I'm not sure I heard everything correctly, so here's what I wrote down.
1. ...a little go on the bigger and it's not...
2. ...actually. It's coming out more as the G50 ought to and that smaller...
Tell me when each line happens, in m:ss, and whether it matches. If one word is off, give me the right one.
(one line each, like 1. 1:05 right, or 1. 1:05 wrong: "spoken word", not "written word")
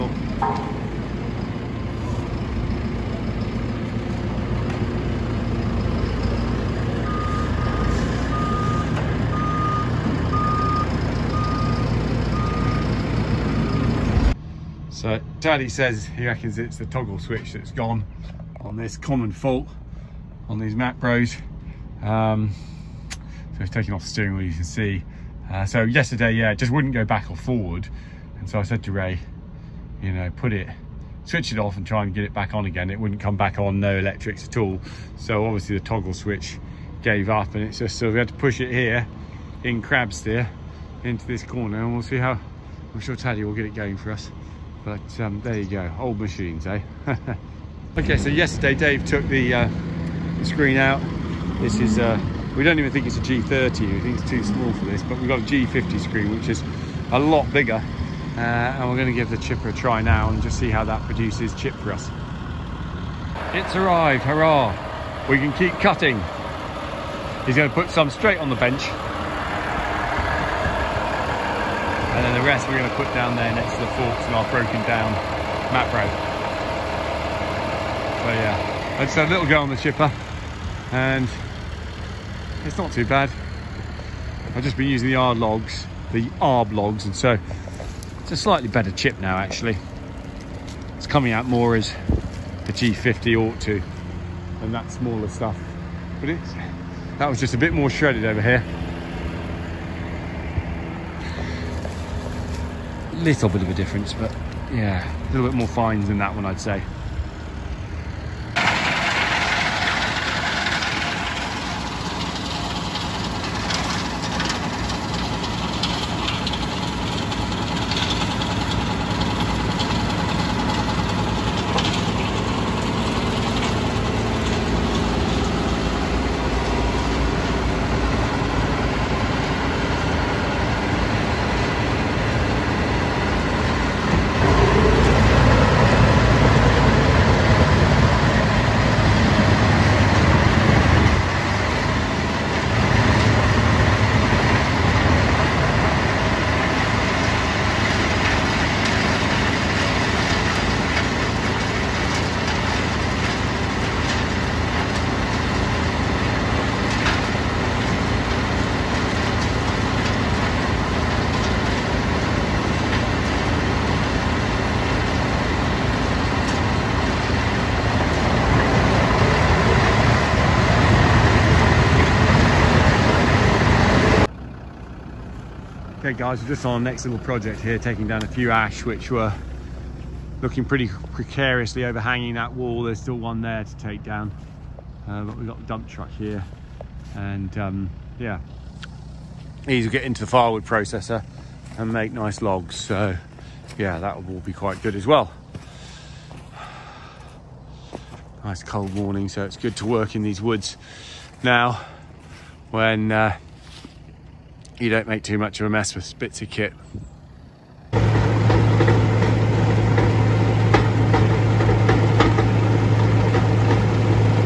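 1. 1:19 wrong: "chipper", not "bigger"
2. 1:29 right.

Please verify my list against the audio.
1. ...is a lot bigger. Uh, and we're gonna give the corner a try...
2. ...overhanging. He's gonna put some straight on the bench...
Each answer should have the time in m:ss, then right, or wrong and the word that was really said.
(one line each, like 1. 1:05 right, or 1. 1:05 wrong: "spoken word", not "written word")
1. 0:56 wrong: "chipper", not "corner"
2. 1:05 wrong: "cutting", not "overhanging".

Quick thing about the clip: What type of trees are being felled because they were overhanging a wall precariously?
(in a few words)
ash.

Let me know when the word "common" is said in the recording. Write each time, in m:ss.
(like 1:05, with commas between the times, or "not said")
0:18.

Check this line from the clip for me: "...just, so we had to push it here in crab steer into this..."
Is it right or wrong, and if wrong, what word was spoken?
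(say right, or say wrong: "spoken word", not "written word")
right.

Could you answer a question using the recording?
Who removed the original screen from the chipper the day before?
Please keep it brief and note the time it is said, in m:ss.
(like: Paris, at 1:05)
Dave, at 0:48.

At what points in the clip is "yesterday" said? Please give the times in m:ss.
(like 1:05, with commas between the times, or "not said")
0:25, 0:48.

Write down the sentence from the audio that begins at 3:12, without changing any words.
So yeah, that will be quite good as well.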